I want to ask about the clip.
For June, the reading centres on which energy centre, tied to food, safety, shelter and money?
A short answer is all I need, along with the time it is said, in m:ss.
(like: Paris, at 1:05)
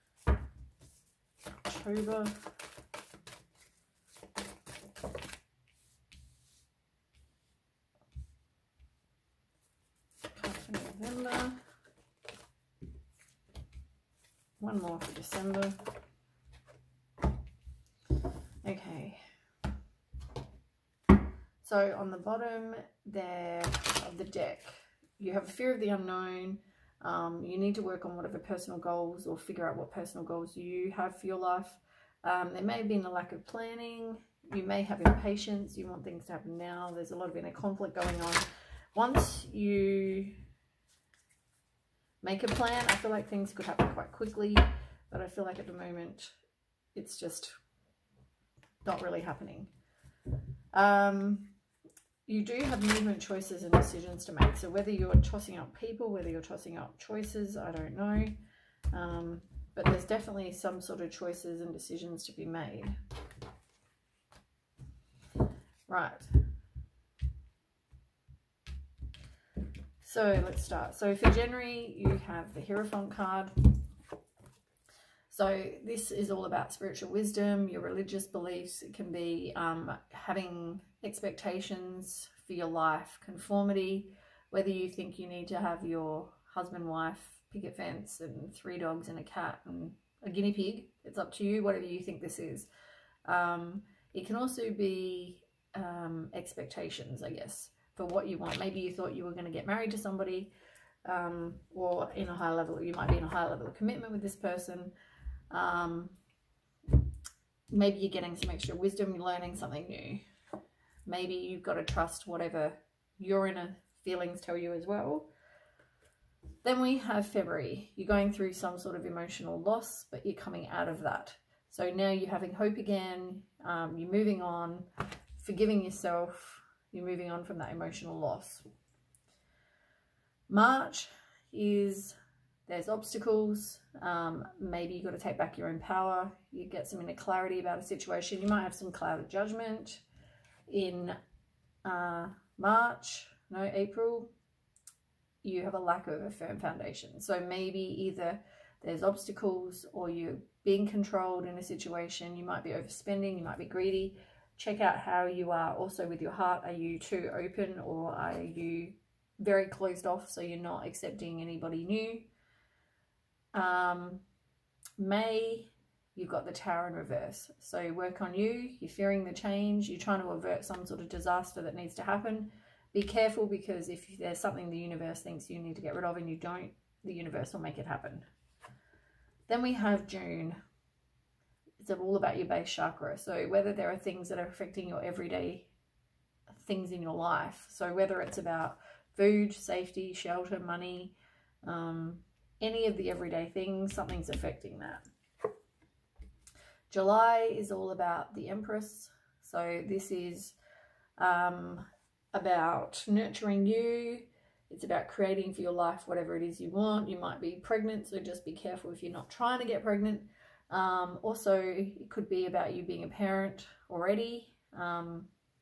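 Base chakra, at 3:02.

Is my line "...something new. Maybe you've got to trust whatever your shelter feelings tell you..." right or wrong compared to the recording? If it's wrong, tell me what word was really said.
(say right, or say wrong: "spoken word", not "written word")
wrong: "inner", not "shelter".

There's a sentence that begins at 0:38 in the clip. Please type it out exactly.
Once you make a plan, I feel like things could happen quite quickly.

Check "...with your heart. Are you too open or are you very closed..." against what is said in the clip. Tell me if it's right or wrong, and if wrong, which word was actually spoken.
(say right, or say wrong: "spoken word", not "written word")
right.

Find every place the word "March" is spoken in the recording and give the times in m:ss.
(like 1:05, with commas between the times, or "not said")
2:10, 2:22.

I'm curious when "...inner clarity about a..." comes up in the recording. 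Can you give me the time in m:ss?
2:17.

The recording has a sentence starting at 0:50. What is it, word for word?
Um, you do have movement choices and decisions to make.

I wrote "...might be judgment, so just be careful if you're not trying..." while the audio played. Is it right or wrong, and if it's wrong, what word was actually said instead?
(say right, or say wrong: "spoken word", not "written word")
wrong: "pregnant", not "judgment".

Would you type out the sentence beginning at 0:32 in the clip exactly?
Um, there may have been a lack of planning.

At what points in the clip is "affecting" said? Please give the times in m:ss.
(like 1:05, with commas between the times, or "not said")
3:04, 3:14.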